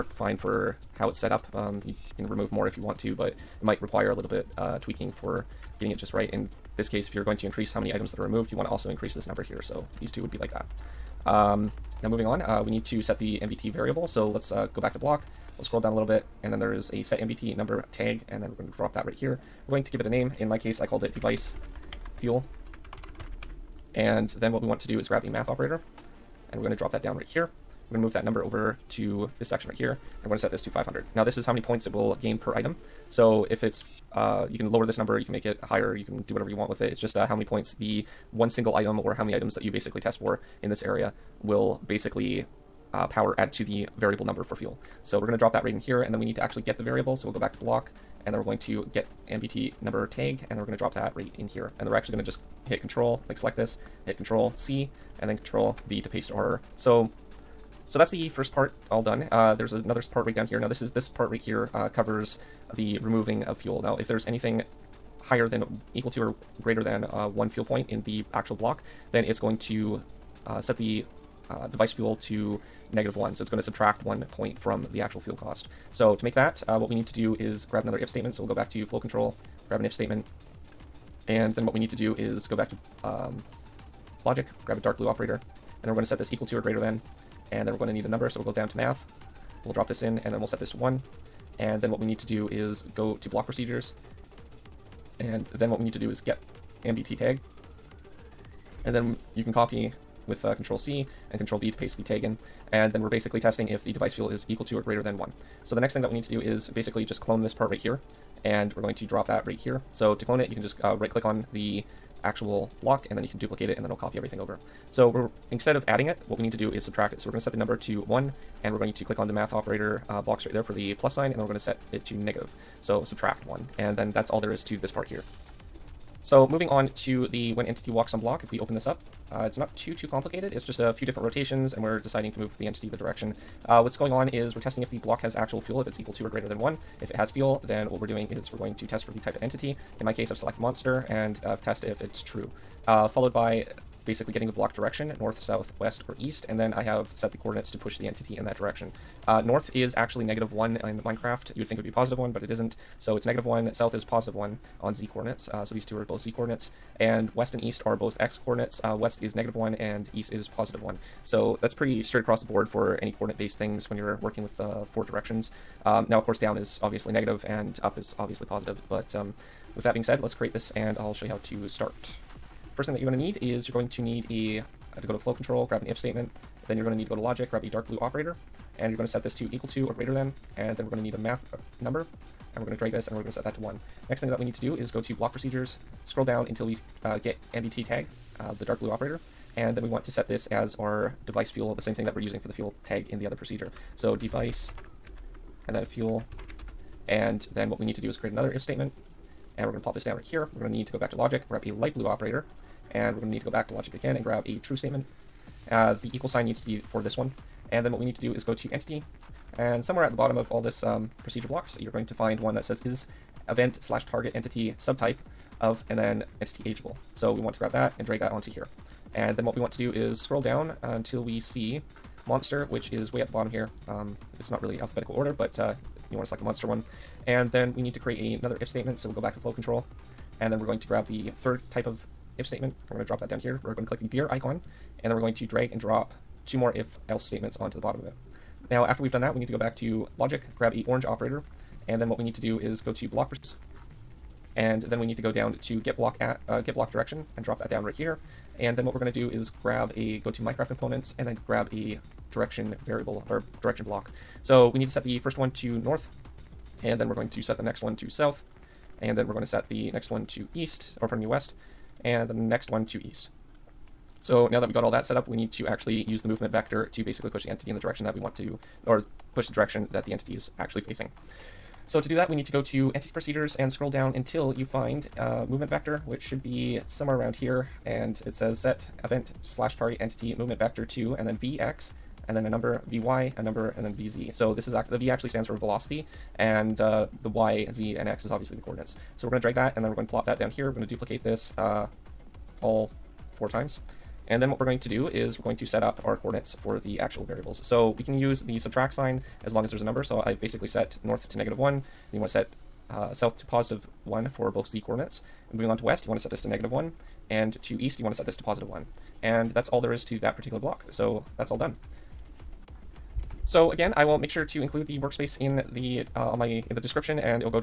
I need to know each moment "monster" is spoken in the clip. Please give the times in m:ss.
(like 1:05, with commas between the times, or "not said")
2:20, 3:42, 3:46.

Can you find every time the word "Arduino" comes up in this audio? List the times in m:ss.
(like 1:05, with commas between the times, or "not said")
not said.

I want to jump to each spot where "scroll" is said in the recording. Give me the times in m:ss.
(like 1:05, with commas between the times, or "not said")
0:15, 3:06, 3:40, 4:33.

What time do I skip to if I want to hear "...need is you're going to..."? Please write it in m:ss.
2:53.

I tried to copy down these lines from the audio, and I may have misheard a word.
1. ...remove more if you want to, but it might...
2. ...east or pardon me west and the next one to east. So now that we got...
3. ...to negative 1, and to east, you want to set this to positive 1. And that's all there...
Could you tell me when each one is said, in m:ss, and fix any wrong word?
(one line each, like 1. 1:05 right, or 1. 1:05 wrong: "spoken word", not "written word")
1. 0:02 right
2. 4:20 right
3. 5:06 right.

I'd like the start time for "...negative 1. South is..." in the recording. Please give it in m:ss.
2:33.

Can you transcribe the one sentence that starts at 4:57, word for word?
So we can use the subtract sign as long as there's a number.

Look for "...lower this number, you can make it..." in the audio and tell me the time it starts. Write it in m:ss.
0:34.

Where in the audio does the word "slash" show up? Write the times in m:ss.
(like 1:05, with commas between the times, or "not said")
3:33, 4:39.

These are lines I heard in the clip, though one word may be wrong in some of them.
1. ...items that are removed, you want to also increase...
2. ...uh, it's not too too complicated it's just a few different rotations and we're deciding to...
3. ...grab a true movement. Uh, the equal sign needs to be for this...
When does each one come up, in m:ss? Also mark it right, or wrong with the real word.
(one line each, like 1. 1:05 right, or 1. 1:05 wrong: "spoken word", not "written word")
1. 0:07 right
2. 2:09 right
3. 3:24 wrong: "statement", not "movement".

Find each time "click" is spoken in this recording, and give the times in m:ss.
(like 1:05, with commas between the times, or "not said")
1:51, 1:59, 3:53.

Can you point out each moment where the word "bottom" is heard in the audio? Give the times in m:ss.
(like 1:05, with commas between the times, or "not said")
3:30, 3:43, 3:57.